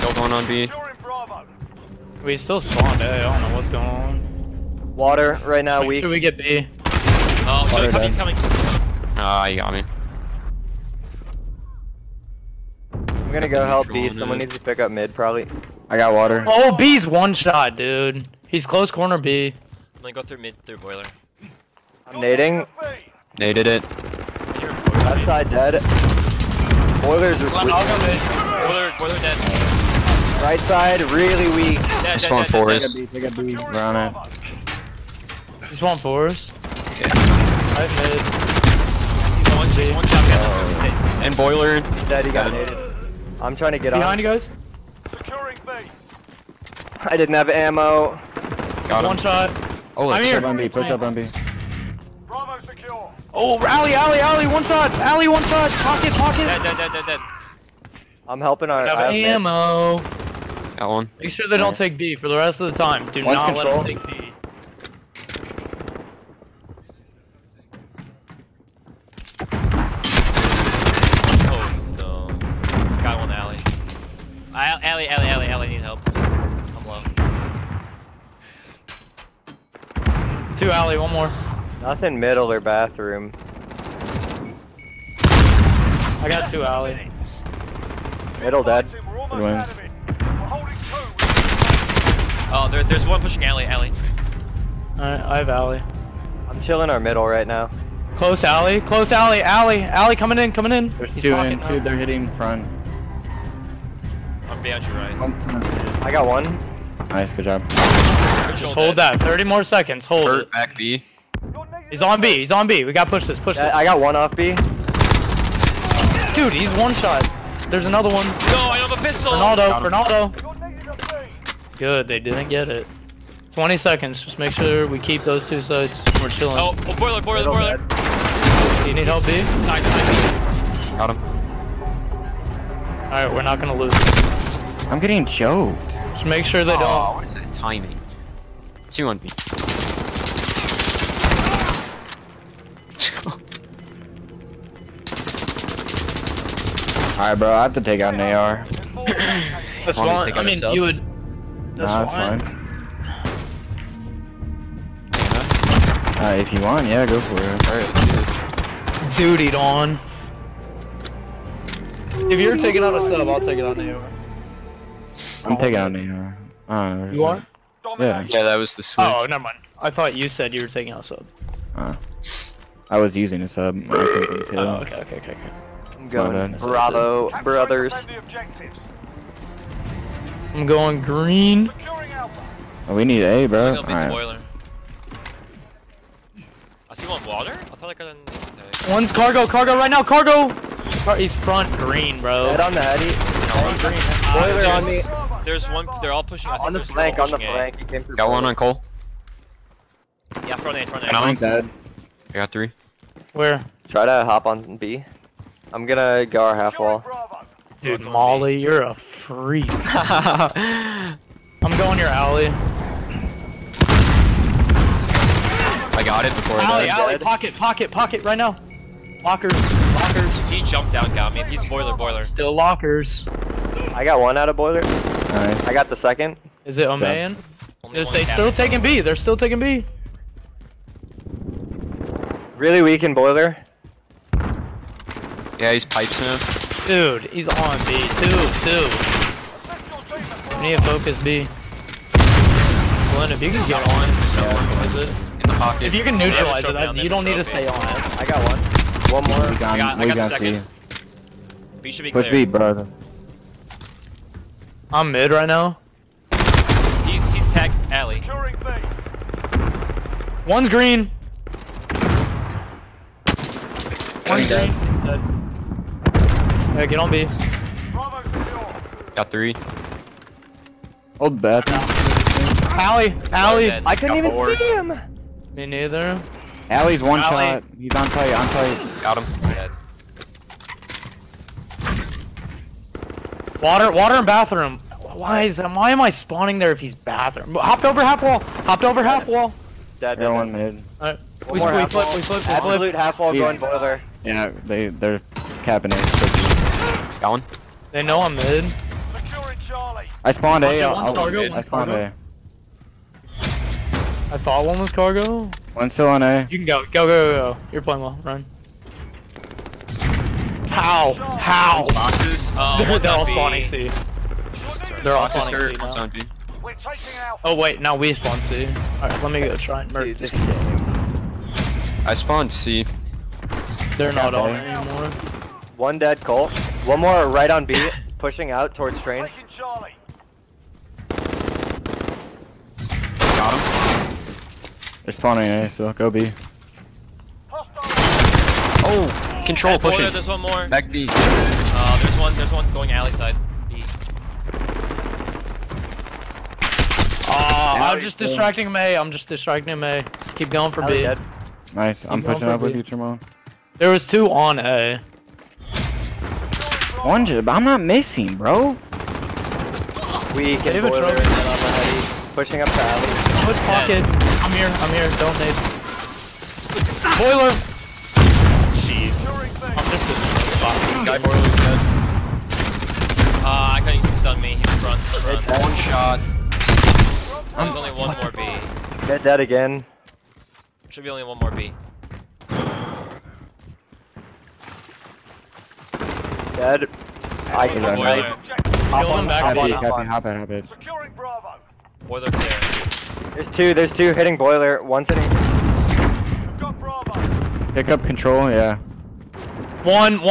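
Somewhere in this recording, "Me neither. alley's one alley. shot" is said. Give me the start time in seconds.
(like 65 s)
275 s.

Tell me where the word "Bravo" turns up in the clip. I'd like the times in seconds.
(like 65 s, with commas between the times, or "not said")
52 s, 176 s, 391 s.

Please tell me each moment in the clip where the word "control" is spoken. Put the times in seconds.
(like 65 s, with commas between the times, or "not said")
63 s, 339 s, 398 s.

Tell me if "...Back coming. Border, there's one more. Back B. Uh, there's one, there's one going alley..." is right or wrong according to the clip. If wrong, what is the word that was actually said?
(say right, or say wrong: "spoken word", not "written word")
wrong: "pushing", not "coming".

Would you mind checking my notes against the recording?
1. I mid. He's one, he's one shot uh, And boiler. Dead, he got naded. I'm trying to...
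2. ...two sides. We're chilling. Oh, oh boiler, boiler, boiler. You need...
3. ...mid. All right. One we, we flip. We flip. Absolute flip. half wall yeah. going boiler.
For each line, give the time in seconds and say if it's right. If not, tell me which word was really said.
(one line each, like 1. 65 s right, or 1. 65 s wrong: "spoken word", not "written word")
1. 37 s right
2. 125 s right
3. 290 s right.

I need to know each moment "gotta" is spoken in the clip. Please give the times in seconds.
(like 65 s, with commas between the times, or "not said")
112 s.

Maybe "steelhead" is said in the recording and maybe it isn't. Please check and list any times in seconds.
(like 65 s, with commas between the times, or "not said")
not said.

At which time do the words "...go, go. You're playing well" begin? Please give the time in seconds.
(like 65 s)
307 s.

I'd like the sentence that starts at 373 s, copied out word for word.
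Uh, I can't even stun me, he's front, he's front.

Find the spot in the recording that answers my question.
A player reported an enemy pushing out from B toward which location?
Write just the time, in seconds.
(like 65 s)
328 s.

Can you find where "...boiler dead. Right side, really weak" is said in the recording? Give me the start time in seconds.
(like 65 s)
28 s.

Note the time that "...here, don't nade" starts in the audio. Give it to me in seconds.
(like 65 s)
364 s.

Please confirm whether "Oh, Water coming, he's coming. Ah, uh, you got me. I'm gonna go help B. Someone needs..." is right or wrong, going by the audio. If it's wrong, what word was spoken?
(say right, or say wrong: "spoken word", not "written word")
right.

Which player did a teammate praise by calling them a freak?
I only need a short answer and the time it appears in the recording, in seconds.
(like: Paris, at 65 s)
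Molly, at 207 s.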